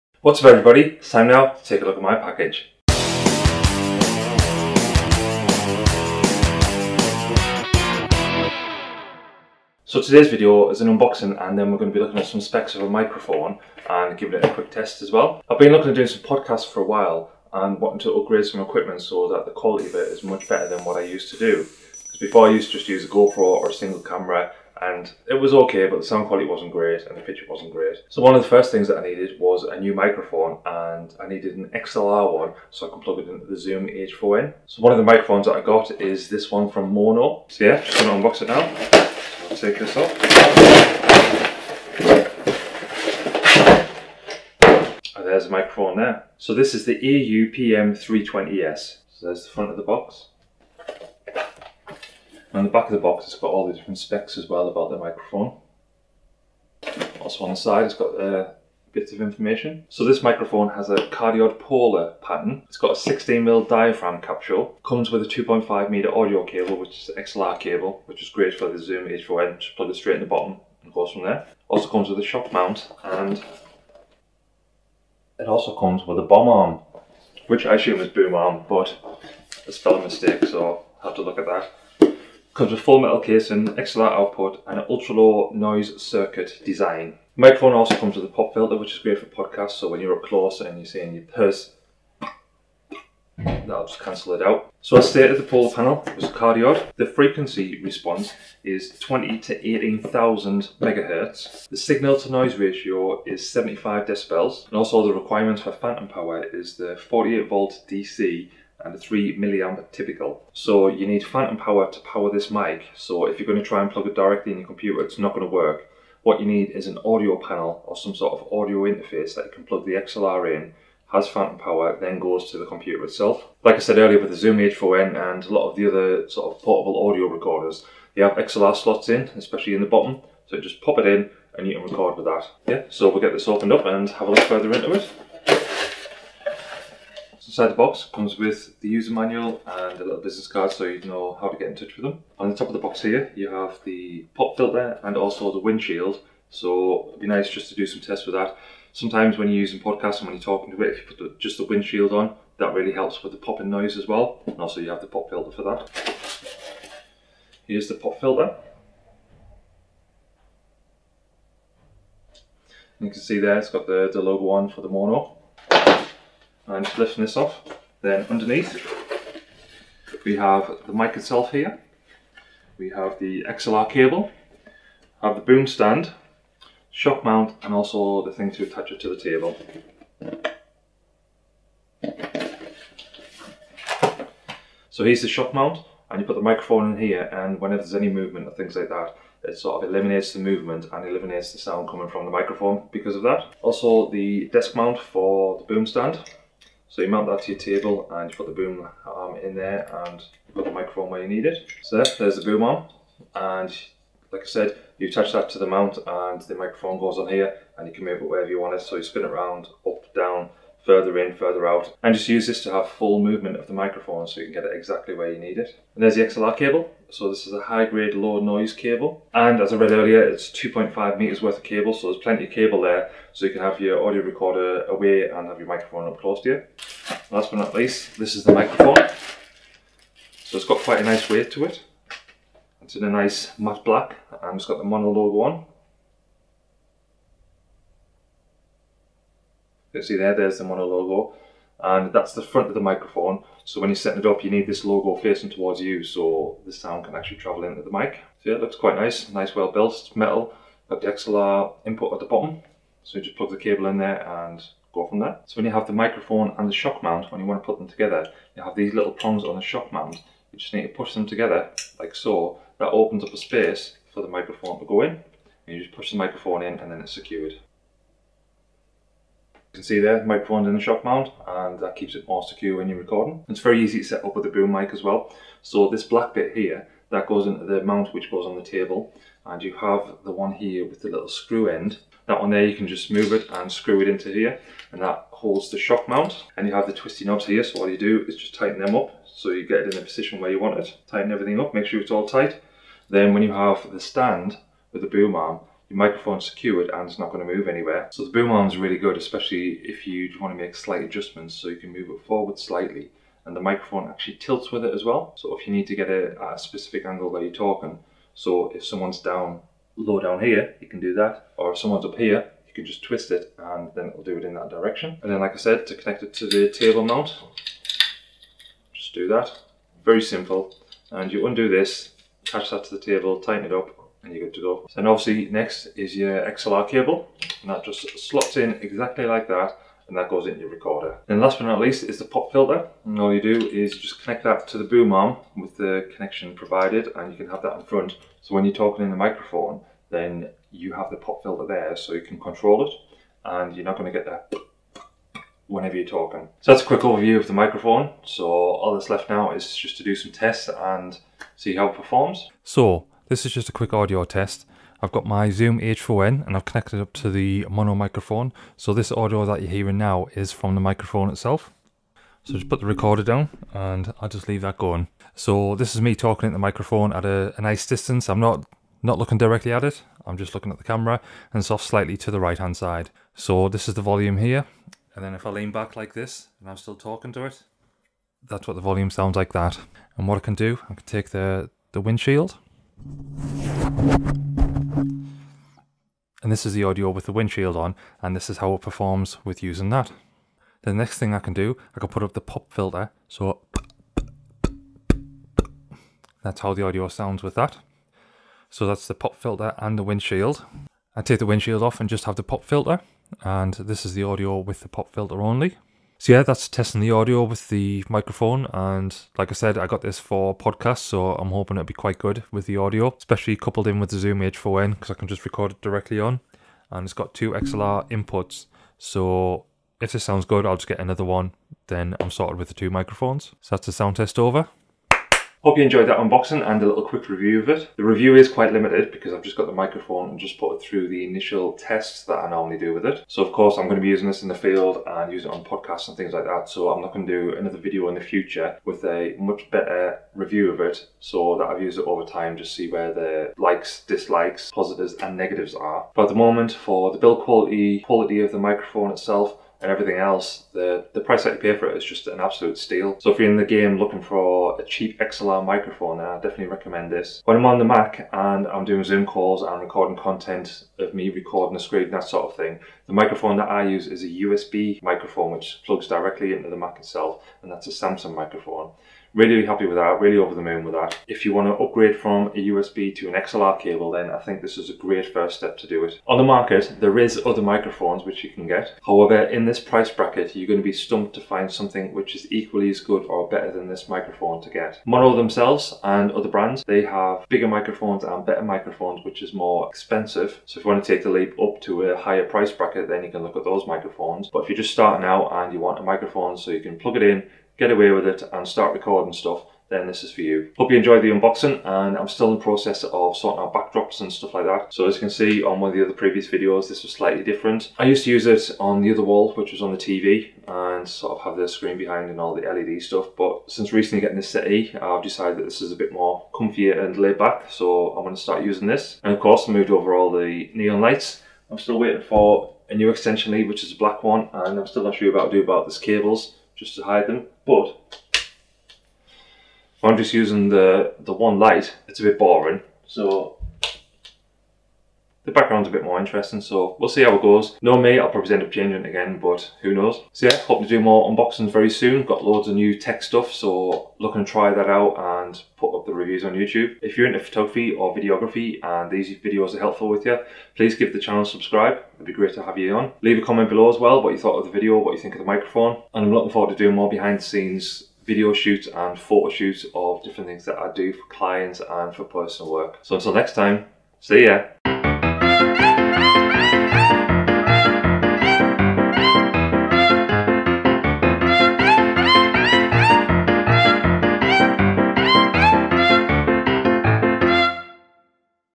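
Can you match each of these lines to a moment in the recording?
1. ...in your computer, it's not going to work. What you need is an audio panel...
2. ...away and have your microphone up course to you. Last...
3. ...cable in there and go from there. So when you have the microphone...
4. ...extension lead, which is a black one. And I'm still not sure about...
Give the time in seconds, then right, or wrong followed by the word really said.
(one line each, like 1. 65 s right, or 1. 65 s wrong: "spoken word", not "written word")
1. 114 s right
2. 224 s wrong: "close", not "course"
3. 253 s right
4. 523 s right.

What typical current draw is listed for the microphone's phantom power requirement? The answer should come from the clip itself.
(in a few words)
3 milliamps.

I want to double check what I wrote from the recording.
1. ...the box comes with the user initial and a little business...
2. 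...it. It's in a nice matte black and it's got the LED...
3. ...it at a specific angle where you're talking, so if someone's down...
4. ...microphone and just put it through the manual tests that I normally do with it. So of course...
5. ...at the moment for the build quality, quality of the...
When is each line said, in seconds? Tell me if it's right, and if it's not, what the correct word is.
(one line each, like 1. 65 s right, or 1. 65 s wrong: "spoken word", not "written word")
1. 137 s wrong: "manual", not "initial"
2. 231 s wrong: "Maono", not "LED"
3. 306 s right
4. 429 s wrong: "initial", not "manual"
5. 446 s right.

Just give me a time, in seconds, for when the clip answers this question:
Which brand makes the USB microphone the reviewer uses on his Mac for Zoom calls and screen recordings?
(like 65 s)
467 s.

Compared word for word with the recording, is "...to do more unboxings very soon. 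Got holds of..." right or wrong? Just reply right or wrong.
wrong.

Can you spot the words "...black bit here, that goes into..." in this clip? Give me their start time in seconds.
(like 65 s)
276 s.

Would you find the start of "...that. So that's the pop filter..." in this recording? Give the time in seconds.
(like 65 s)
397 s.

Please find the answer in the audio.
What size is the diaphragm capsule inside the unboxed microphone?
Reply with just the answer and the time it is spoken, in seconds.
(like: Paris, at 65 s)
16mm, at 62 s.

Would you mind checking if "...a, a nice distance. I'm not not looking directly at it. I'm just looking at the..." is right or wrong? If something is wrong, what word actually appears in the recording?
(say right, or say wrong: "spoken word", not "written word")
right.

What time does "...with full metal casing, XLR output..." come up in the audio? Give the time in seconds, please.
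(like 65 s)
82 s.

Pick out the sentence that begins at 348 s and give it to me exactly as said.
So all that's left now is just to do some tests and see how it performs.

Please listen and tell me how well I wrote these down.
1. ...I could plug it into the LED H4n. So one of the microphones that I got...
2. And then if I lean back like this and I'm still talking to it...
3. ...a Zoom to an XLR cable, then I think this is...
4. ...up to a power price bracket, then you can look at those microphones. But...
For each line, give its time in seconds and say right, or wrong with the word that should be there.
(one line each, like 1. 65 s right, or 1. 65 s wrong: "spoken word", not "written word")
1. 32 s wrong: "Zoom", not "LED"
2. 375 s right
3. 472 s wrong: "USB", not "Zoom"
4. 491 s wrong: "higher", not "power".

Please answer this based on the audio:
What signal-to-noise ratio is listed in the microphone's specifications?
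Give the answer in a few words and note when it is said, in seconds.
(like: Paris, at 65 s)
75 decibels, at 103 s.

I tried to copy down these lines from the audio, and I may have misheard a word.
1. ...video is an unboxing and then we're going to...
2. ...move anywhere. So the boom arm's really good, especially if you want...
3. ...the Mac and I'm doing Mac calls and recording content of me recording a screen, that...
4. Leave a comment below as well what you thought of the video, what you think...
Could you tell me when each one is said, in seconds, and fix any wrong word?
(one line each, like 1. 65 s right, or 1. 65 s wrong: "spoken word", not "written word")
1. 10 s right
2. 297 s right
3. 457 s wrong: "Zoom", not "Mac"
4. 553 s right.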